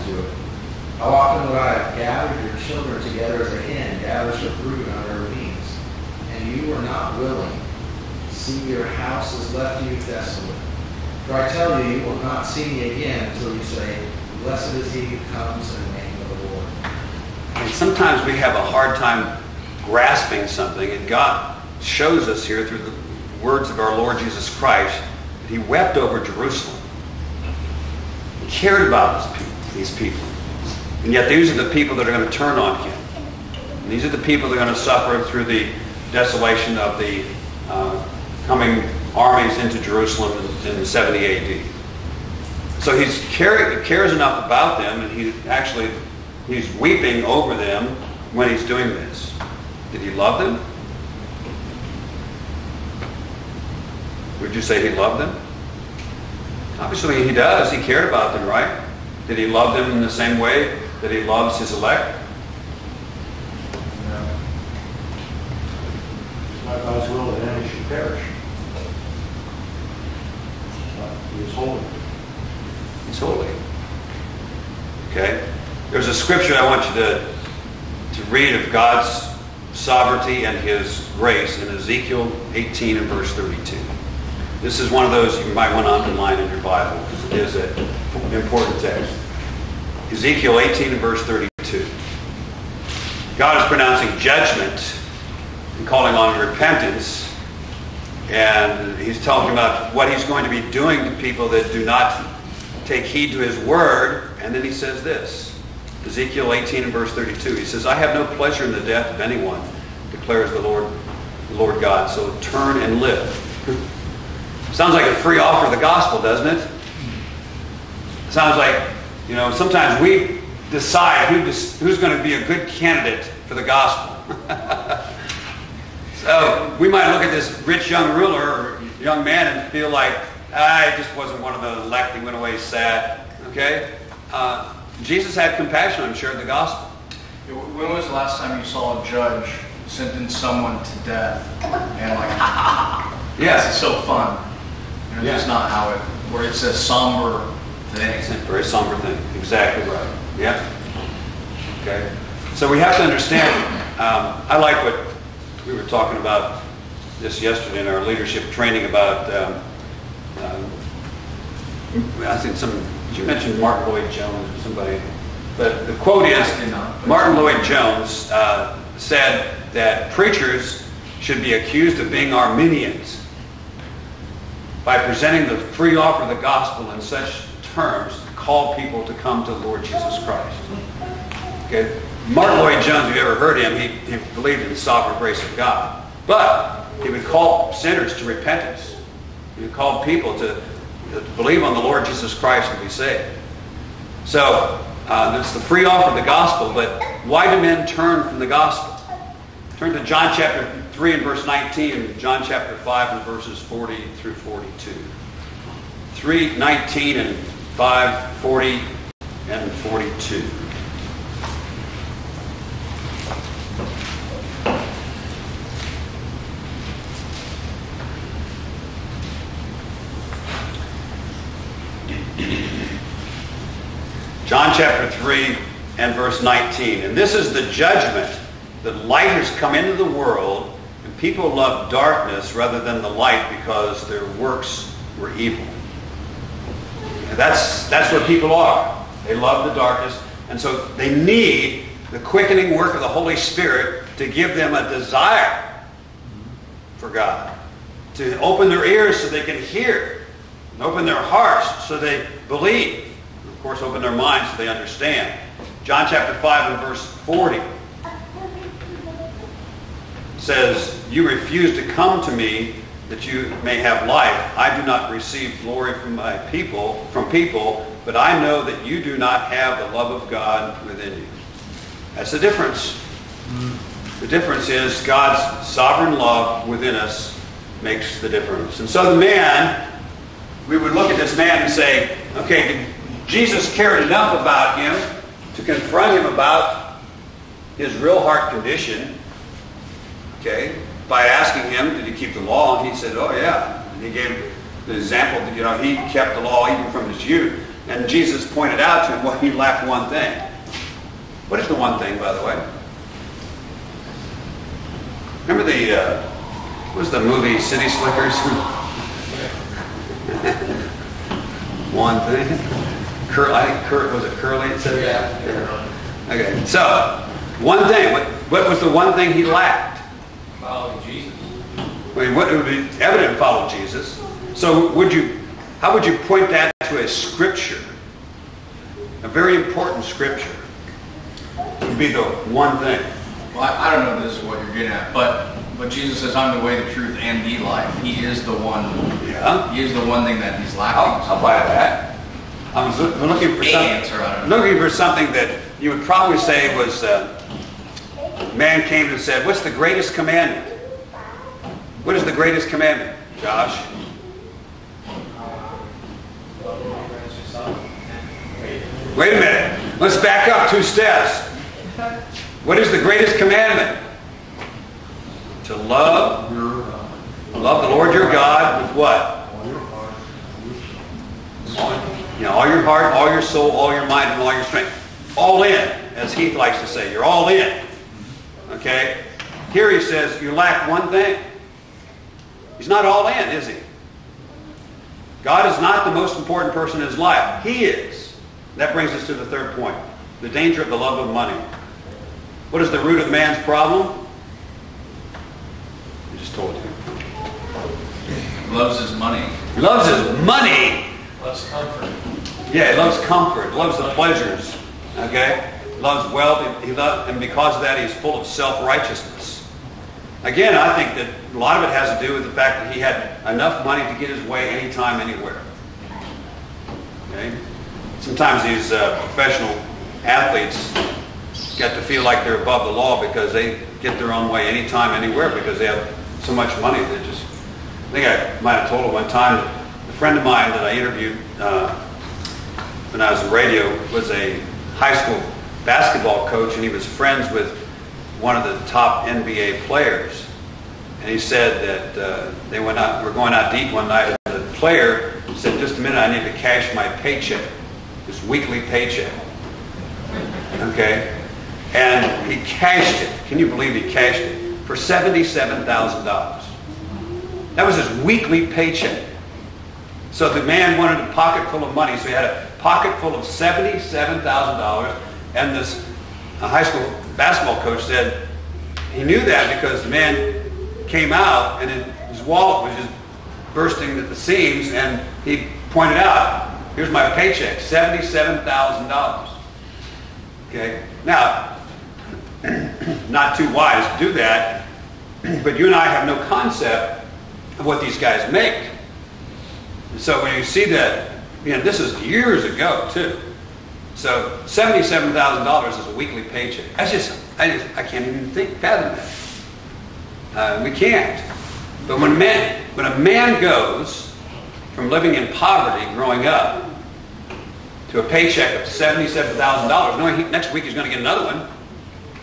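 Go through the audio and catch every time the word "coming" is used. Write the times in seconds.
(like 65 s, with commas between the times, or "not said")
38 s.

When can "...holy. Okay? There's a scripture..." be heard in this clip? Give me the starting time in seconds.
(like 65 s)
73 s.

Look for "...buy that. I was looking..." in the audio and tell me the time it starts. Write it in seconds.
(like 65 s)
341 s.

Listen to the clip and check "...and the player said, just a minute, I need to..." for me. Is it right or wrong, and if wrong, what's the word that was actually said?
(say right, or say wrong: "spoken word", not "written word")
right.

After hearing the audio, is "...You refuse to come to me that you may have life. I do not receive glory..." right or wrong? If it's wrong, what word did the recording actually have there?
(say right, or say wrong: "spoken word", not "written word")
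right.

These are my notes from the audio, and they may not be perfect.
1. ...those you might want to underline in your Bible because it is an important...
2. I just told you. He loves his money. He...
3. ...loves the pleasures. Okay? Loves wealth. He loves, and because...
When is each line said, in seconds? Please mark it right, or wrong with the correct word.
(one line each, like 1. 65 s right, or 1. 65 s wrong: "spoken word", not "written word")
1. 85 s right
2. 396 s right
3. 403 s right.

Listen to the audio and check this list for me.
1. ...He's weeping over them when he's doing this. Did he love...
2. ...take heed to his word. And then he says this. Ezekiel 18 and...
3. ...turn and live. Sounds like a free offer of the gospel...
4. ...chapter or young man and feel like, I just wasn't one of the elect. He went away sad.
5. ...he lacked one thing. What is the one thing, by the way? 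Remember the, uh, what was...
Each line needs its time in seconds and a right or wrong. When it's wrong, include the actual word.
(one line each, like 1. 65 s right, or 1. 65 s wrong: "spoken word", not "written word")
1. 46 s right
2. 102 s right
3. 112 s right
4. 128 s wrong: "ruler", not "chapter"
5. 299 s right.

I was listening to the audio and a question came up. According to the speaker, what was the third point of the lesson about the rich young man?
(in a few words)
The danger of the love of money.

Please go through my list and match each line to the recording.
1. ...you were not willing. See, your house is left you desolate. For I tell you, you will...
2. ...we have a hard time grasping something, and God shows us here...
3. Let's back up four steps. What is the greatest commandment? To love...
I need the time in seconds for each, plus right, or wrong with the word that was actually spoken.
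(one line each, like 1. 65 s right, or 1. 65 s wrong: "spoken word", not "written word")
1. 6 s right
2. 18 s right
3. 359 s wrong: "two", not "four".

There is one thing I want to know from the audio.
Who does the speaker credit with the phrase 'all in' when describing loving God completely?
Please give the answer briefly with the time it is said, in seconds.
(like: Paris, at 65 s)
Heath, at 376 s.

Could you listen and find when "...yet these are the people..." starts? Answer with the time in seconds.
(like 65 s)
31 s.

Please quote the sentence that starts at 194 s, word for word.
So uh, it's the free offer of the gospel, but why do men turn from the gospel?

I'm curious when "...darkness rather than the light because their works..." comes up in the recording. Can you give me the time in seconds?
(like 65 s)
231 s.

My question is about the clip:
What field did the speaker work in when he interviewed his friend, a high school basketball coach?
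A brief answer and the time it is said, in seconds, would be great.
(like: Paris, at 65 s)
Radio, at 433 s.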